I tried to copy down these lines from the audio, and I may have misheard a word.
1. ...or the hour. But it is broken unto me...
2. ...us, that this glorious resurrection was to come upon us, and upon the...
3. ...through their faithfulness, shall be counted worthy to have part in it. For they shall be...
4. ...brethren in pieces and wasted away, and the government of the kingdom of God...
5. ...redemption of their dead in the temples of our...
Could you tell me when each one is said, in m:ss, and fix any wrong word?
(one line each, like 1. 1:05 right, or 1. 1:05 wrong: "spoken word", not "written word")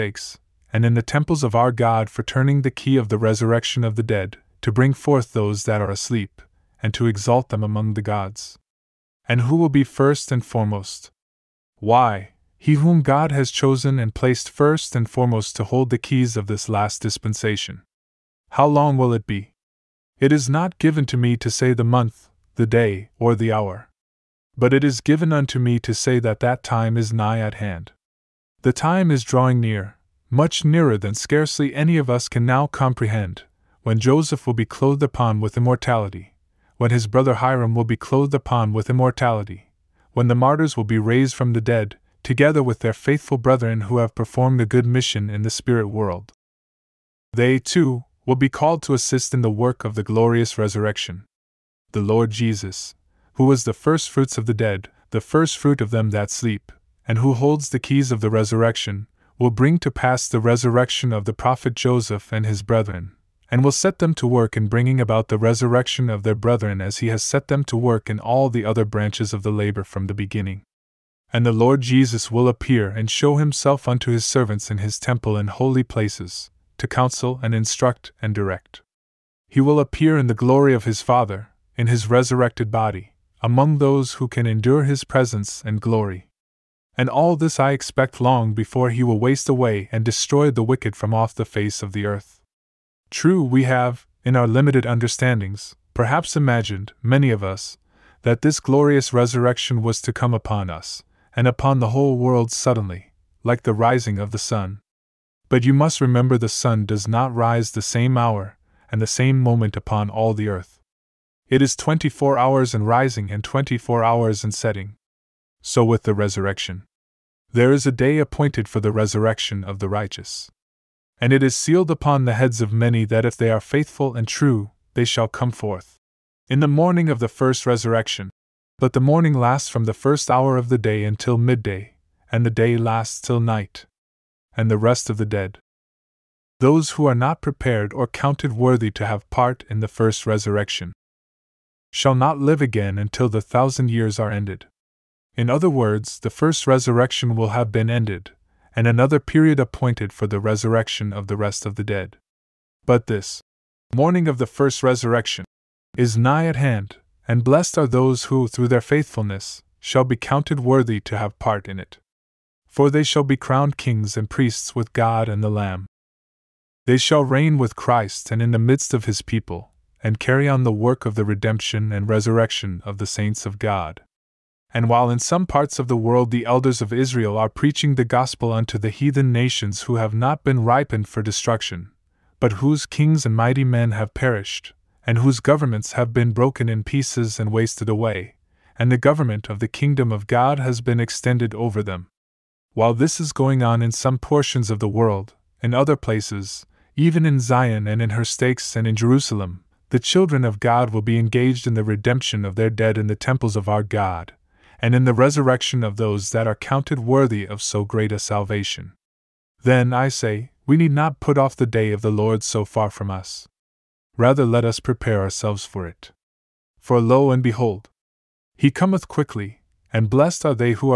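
1. 0:23 wrong: "given", not "broken"
2. 1:37 right
3. 2:38 right
4. 3:06 wrong: "broken", not "brethren"
5. 3:21 right.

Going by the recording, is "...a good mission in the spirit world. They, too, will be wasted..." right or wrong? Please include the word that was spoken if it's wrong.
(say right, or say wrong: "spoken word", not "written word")
wrong: "called", not "wasted".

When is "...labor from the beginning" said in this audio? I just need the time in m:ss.
1:09.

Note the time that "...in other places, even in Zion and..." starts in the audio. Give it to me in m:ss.
3:15.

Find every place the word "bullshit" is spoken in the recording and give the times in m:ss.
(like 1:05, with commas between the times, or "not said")
not said.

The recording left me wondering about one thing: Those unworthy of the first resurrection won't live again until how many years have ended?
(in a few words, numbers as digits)
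1,000.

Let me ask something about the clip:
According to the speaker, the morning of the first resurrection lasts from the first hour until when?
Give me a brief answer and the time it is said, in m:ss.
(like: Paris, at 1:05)
Midday, at 2:11.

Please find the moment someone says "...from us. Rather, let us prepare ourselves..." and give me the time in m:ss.
3:32.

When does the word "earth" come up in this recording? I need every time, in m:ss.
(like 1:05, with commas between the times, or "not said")
1:32, 1:50.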